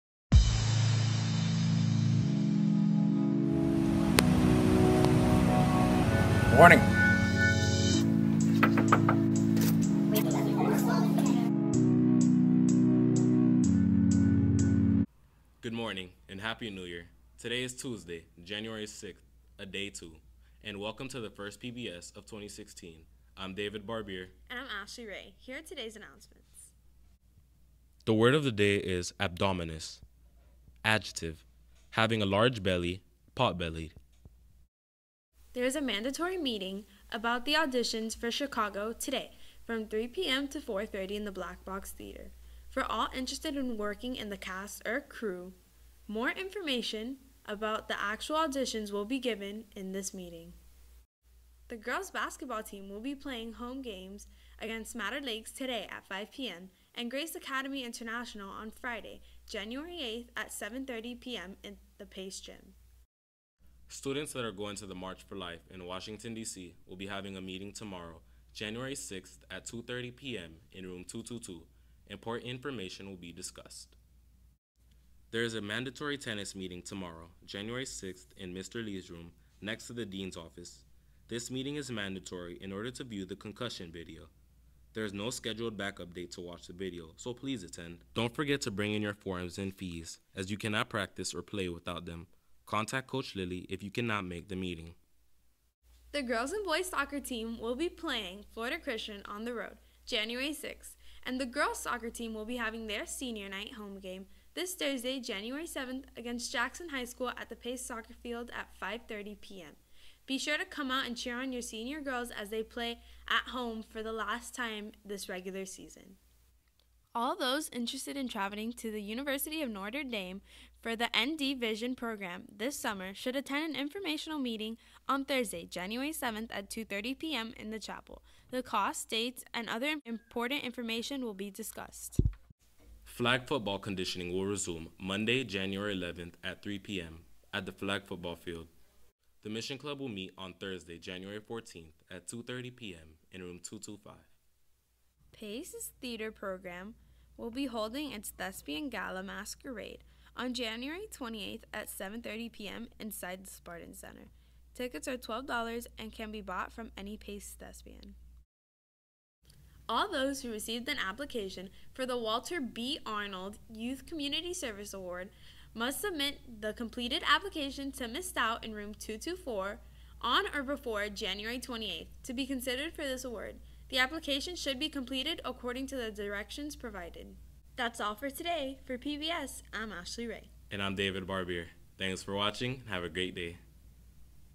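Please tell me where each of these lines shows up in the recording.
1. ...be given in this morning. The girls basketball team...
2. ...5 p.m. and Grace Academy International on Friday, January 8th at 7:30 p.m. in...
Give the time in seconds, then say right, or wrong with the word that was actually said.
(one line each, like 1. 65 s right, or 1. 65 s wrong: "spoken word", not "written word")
1. 49 s wrong: "meeting", not "morning"
2. 56 s right.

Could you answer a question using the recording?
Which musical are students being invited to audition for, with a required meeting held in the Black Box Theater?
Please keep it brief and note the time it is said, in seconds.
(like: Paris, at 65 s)
Chicago, at 38 s.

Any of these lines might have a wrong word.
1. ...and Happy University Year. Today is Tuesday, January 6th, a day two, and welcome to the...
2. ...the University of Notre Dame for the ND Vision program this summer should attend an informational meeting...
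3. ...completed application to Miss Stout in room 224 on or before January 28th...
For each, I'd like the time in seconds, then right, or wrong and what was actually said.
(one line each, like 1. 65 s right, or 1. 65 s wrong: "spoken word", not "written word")
1. 16 s wrong: "New", not "University"
2. 118 s right
3. 166 s right.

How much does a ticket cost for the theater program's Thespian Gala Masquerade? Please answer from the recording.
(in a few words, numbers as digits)
$12.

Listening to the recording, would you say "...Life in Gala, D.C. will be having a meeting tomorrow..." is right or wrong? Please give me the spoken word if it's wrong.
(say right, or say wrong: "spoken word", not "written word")
wrong: "Washington", not "Gala".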